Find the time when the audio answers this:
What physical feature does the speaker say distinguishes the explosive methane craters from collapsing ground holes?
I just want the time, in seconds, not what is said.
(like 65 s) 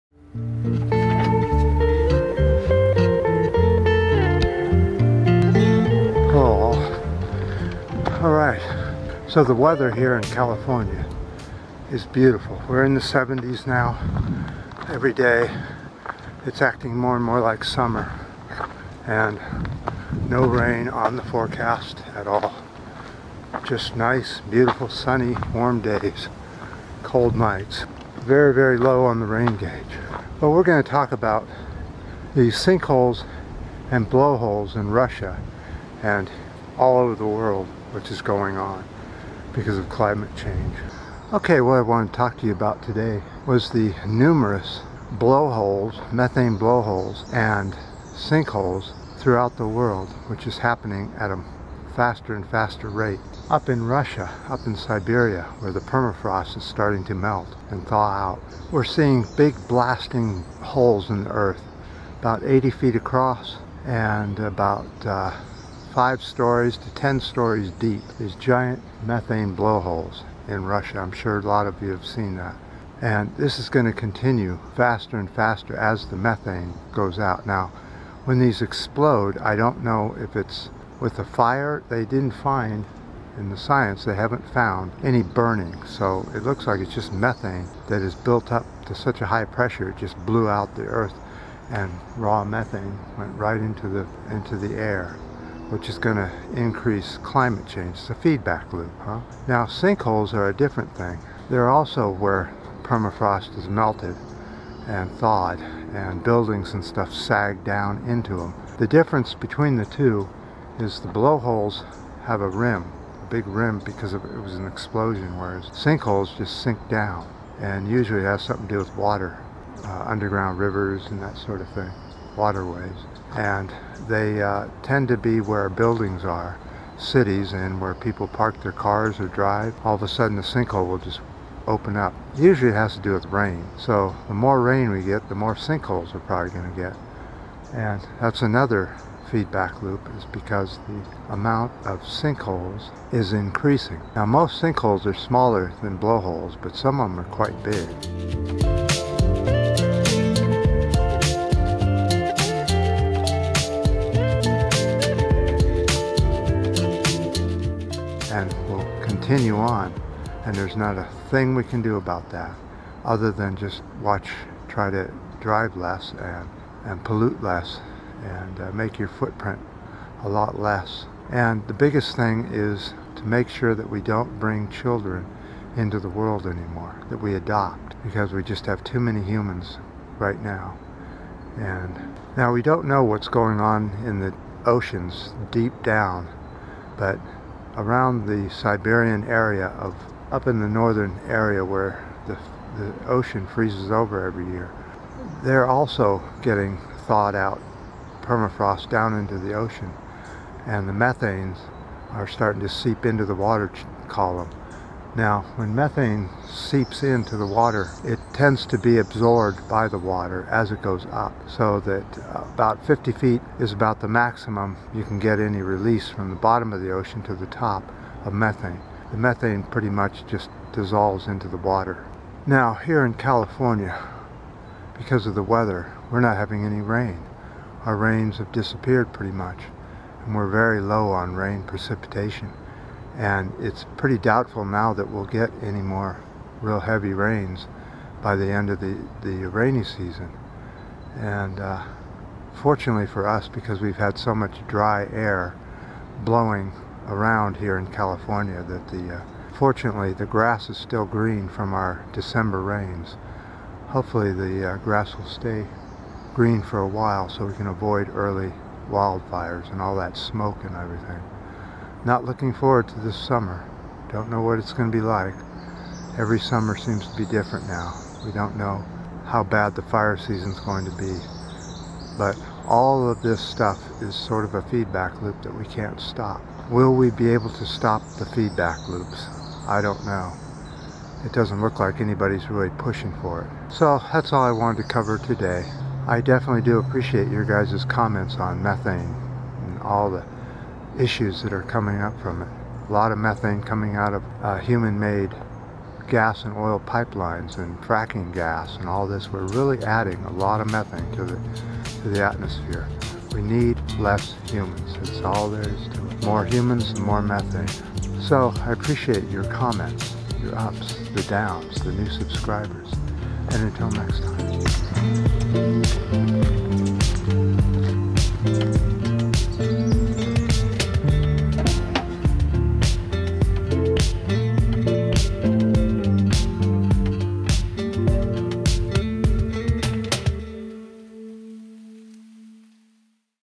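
112 s.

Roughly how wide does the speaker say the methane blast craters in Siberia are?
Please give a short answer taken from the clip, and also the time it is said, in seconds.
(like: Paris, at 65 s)
80 feet, at 62 s.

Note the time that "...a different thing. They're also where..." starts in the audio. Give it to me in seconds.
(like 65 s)
100 s.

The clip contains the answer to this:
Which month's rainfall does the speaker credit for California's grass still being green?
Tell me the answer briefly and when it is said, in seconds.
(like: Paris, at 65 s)
December, at 252 s.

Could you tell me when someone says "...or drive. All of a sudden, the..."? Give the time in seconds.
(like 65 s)
129 s.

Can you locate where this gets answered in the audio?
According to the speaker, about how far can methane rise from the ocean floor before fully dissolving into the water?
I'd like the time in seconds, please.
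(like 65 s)
212 s.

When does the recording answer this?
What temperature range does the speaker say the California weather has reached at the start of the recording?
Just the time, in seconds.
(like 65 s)
12 s.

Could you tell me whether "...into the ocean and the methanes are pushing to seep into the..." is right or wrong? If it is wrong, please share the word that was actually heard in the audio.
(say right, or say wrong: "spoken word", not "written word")
wrong: "starting", not "pushing".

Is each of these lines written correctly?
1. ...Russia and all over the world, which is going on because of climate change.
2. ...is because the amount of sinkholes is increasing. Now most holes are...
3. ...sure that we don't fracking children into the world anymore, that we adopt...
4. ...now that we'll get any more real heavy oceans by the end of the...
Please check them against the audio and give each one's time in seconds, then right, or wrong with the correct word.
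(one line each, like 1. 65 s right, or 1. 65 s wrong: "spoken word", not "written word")
1. 34 s right
2. 140 s wrong: "sinkholes", not "holes"
3. 173 s wrong: "bring", not "fracking"
4. 234 s wrong: "rains", not "oceans".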